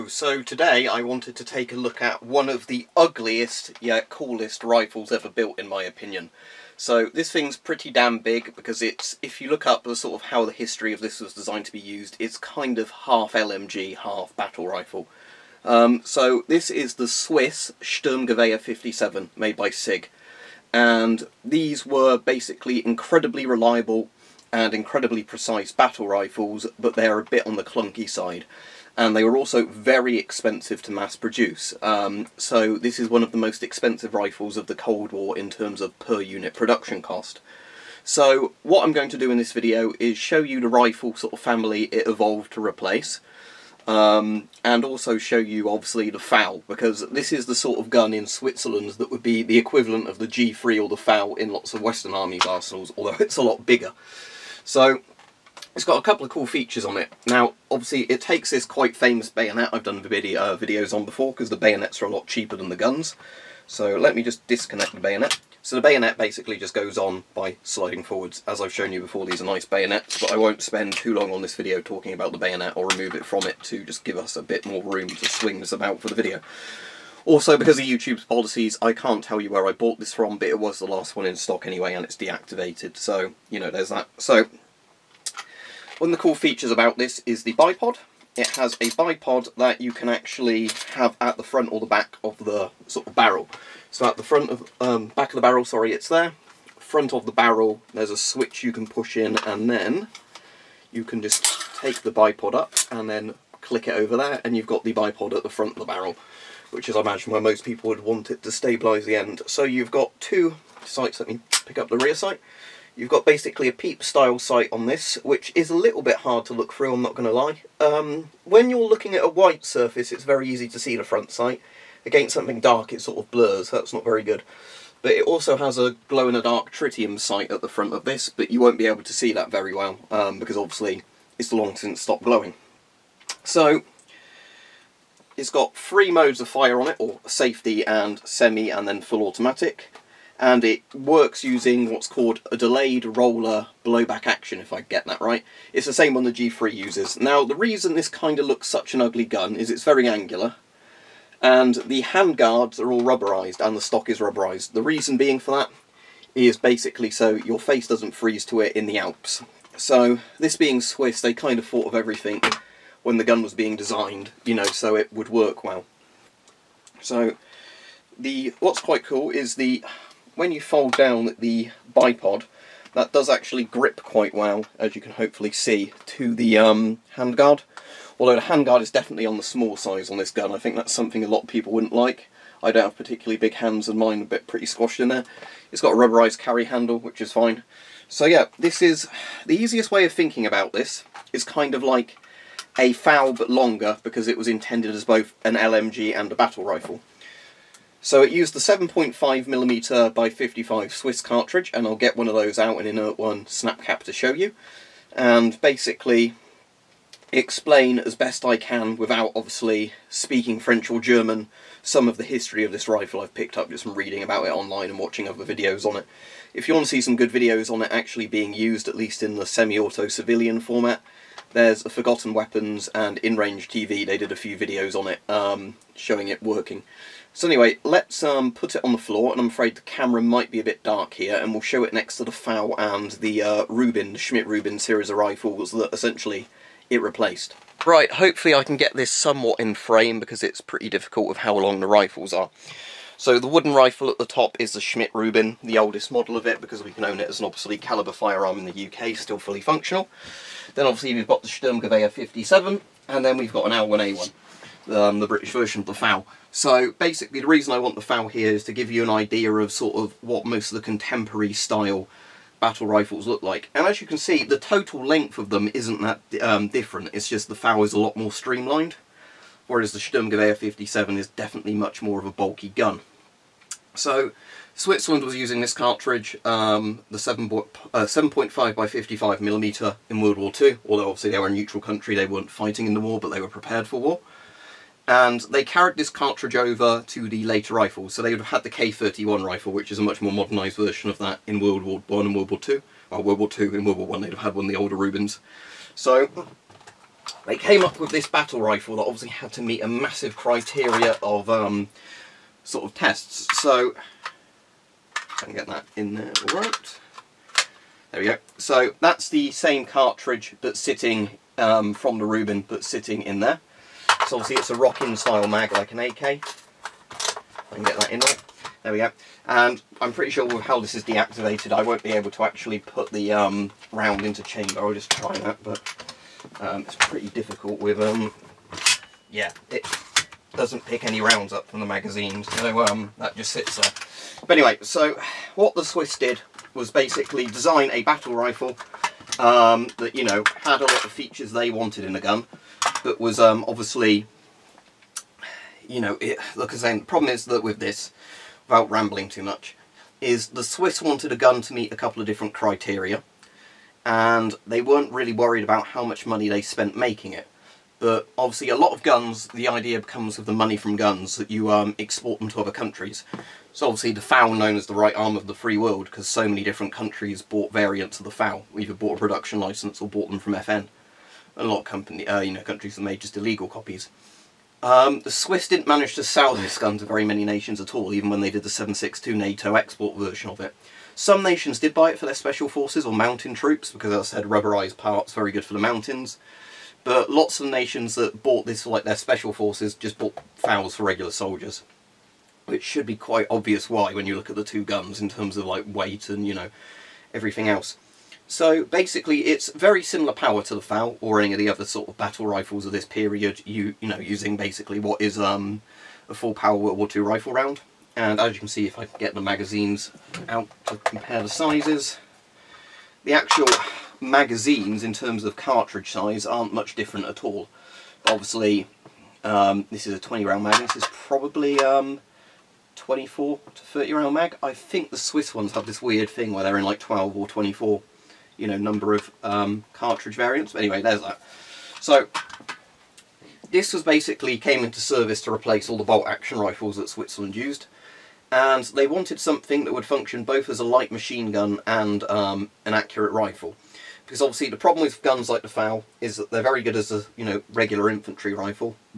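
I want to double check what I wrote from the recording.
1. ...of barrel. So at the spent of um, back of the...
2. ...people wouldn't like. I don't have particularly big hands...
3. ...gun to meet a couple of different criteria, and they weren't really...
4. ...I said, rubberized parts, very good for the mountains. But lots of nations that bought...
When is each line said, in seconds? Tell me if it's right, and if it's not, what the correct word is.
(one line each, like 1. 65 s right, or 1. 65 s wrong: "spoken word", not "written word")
1. 93 s wrong: "front", not "spent"
2. 181 s right
3. 351 s right
4. 384 s right.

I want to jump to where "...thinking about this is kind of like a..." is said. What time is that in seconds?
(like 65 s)
190 s.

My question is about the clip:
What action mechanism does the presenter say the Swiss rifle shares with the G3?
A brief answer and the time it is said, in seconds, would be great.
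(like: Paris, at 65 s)
delayed roller blowback, at 142 s.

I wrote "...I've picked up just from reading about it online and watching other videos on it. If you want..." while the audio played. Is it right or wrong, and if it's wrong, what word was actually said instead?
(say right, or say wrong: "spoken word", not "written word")
right.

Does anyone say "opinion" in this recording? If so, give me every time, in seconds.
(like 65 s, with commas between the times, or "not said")
5 s.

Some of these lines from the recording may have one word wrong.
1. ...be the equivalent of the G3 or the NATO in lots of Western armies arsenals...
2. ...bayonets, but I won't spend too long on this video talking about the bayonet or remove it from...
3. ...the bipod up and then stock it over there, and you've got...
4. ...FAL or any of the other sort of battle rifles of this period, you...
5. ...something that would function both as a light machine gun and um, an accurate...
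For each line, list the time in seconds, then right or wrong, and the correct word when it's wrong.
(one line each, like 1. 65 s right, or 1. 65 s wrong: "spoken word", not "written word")
1. 49 s wrong: "FAL", not "NATO"
2. 69 s right
3. 102 s wrong: "click", not "stock"
4. 400 s right
5. 439 s right.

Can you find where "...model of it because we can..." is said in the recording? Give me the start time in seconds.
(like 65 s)
246 s.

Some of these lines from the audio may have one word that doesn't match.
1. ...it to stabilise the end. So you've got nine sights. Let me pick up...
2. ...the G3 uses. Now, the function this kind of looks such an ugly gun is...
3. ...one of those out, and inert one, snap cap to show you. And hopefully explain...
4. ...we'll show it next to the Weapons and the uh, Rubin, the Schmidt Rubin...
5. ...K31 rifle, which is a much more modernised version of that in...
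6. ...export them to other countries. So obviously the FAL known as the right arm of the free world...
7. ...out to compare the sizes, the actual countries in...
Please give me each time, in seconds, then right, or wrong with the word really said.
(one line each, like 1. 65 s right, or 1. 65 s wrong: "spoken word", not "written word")
1. 108 s wrong: "two", not "nine"
2. 146 s wrong: "reason", not "function"
3. 202 s wrong: "basically", not "hopefully"
4. 231 s wrong: "FAL", not "Weapons"
5. 288 s right
6. 361 s right
7. 410 s wrong: "magazines", not "countries".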